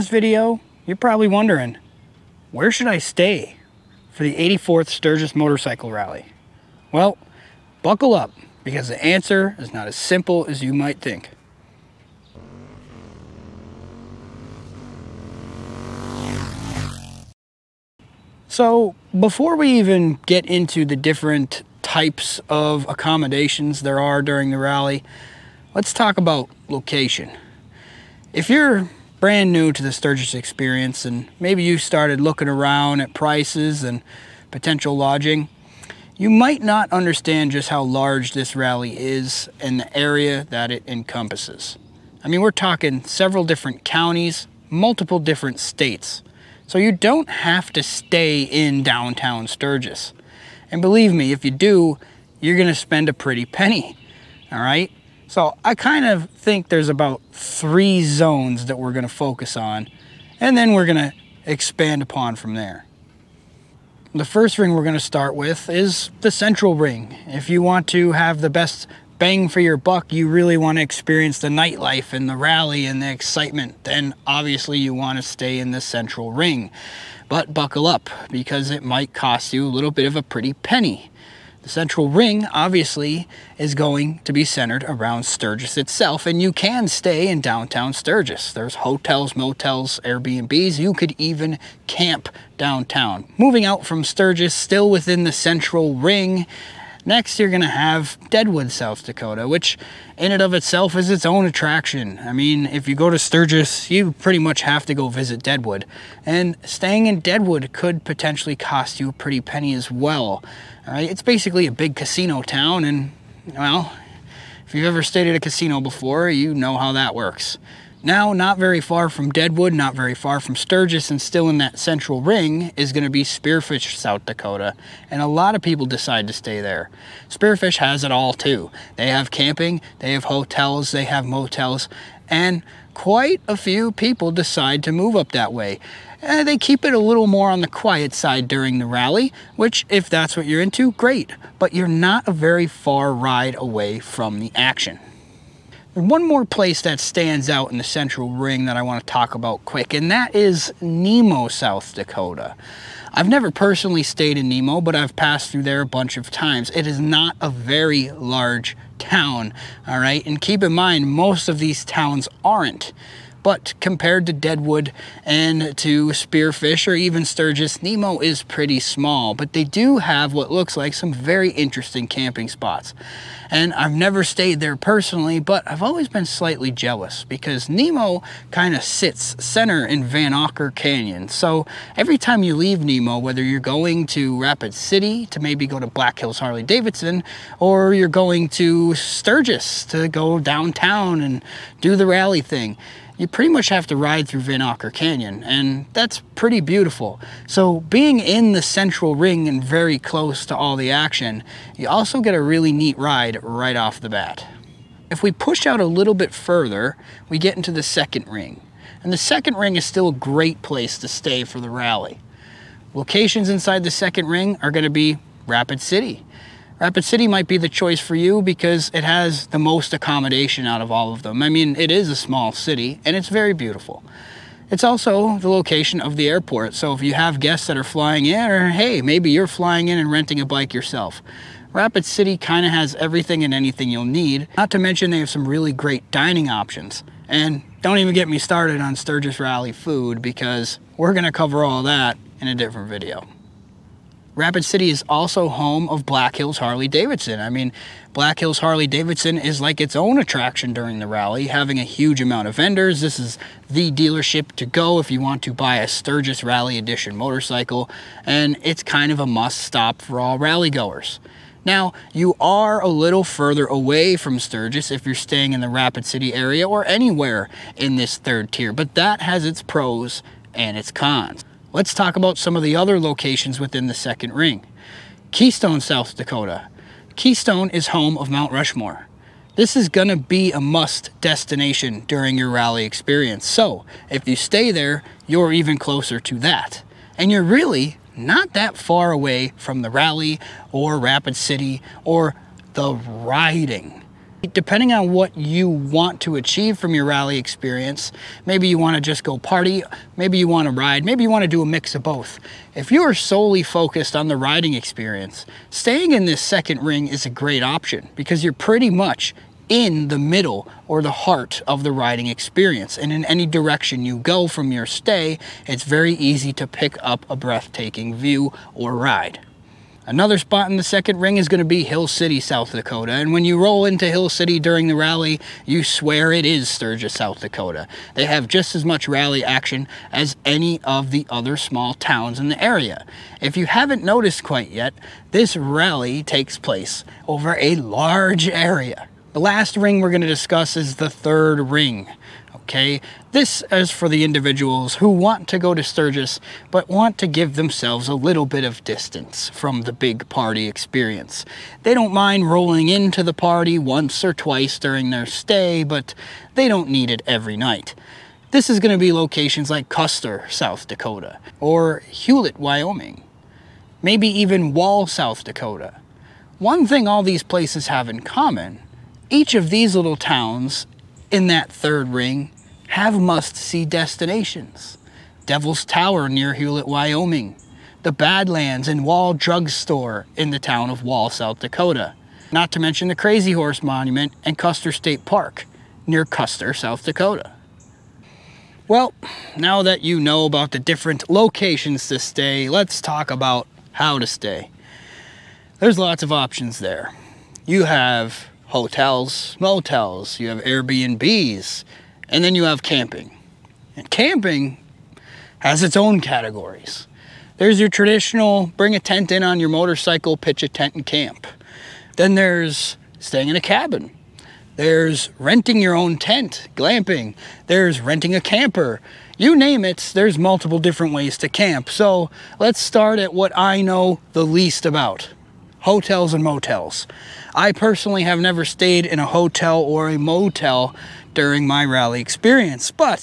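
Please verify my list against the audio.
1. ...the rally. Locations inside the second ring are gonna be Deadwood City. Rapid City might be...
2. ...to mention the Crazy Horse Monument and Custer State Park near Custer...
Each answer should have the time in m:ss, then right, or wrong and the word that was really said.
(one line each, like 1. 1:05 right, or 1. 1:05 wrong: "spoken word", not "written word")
1. 3:31 wrong: "Rapid", not "Deadwood"
2. 6:22 right.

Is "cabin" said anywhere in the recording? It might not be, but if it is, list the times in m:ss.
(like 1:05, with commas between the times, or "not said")
6:53.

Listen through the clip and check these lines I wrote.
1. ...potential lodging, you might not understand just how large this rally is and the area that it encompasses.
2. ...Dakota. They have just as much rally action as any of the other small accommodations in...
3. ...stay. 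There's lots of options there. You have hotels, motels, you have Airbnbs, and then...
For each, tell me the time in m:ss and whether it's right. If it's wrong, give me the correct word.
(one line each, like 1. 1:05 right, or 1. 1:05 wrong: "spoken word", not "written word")
1. 0:34 right
2. 5:27 wrong: "towns", not "accommodations"
3. 6:34 right.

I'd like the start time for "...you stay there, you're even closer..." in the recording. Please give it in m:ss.
4:44.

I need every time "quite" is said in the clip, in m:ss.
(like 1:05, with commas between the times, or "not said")
2:12, 5:34.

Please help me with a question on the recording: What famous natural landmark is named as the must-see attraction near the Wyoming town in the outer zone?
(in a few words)
Devil's Tower.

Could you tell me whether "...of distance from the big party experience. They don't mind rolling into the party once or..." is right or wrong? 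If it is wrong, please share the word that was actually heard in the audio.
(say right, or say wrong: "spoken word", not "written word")
right.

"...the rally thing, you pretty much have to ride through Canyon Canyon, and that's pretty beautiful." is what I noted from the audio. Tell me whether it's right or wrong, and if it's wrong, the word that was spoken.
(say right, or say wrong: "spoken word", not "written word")
wrong: "Vanocker", not "Canyon".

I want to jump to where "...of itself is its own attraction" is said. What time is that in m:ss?
1:40.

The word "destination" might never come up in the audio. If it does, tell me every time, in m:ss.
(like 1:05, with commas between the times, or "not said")
4:41, 6:13.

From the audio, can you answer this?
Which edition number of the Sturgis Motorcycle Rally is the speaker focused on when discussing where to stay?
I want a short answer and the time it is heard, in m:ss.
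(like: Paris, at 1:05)
84th, at 0:04.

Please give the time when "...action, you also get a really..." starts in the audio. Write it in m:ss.
3:20.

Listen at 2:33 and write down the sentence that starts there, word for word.
I've never personally stayed in Nemo, but I've passed through there a bunch of times.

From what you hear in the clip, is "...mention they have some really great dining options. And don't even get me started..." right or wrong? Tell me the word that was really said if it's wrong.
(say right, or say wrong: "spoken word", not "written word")
right.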